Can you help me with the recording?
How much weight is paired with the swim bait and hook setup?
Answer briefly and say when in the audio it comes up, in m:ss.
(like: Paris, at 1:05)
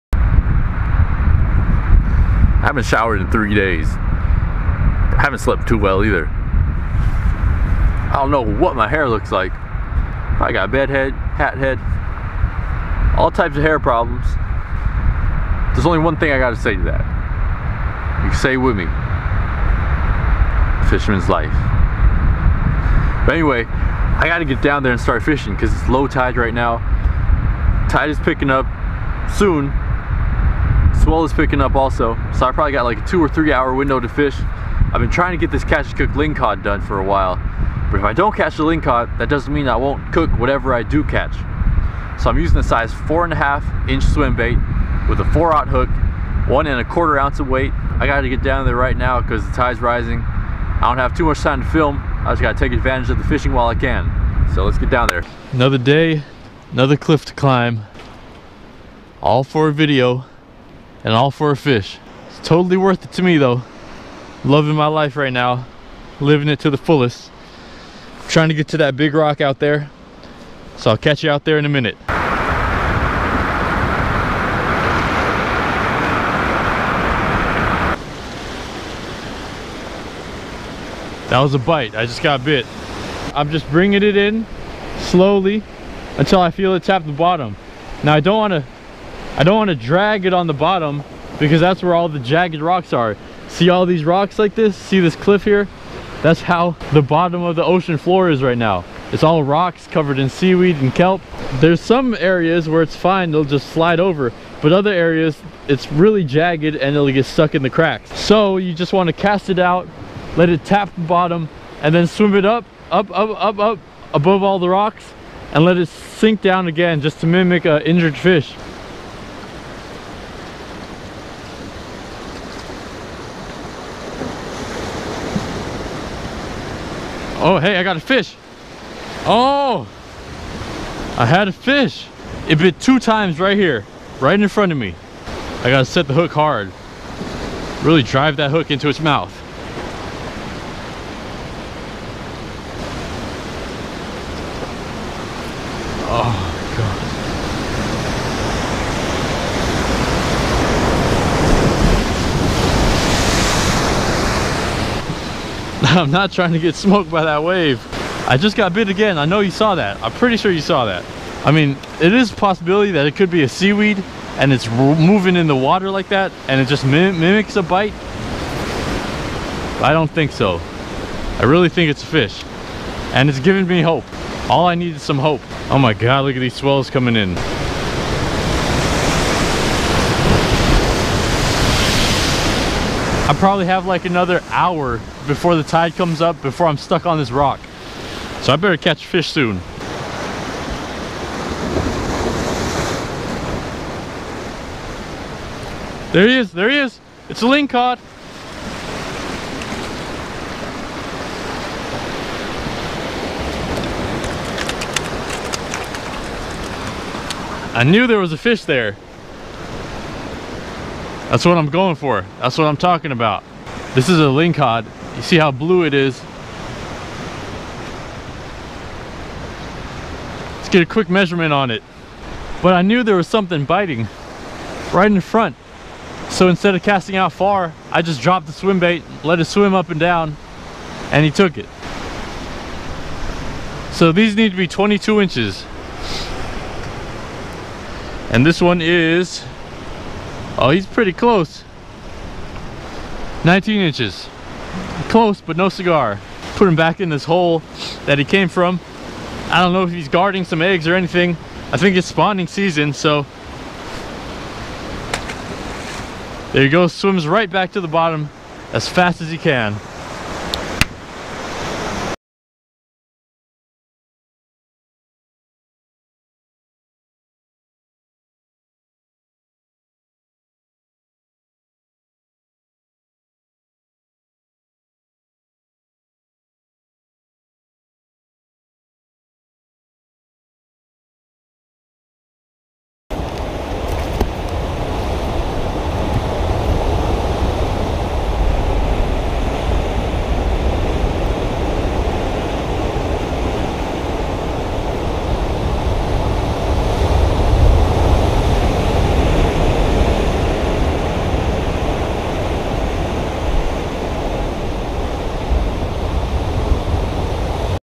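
1.25 ounces, at 0:46.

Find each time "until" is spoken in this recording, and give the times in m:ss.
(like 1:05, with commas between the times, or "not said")
1:26.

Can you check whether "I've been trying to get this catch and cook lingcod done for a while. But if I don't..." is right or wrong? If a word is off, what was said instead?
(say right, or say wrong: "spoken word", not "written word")
right.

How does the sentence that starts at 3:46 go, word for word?
So instead of casting out far, I just dropped the swim bait, let it swim up and down, and he took it.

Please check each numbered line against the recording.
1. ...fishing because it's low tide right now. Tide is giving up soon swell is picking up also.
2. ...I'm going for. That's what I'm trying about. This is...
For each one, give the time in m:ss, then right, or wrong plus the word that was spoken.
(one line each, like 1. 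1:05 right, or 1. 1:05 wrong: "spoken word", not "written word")
1. 0:25 wrong: "picking", not "giving"
2. 3:31 wrong: "talking", not "trying".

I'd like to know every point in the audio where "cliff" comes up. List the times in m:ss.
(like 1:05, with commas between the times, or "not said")
0:56, 1:35.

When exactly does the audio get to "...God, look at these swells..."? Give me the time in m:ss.
2:55.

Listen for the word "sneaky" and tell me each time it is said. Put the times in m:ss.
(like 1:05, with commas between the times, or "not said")
not said.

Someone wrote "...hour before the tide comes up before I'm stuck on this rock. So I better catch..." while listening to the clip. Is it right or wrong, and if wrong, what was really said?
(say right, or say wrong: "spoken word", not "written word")
right.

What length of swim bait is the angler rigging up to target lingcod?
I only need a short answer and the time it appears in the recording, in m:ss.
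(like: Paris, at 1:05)
4.5 inches, at 0:42.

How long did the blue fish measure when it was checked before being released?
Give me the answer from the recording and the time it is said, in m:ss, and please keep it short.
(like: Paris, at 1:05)
19 inches, at 4:03.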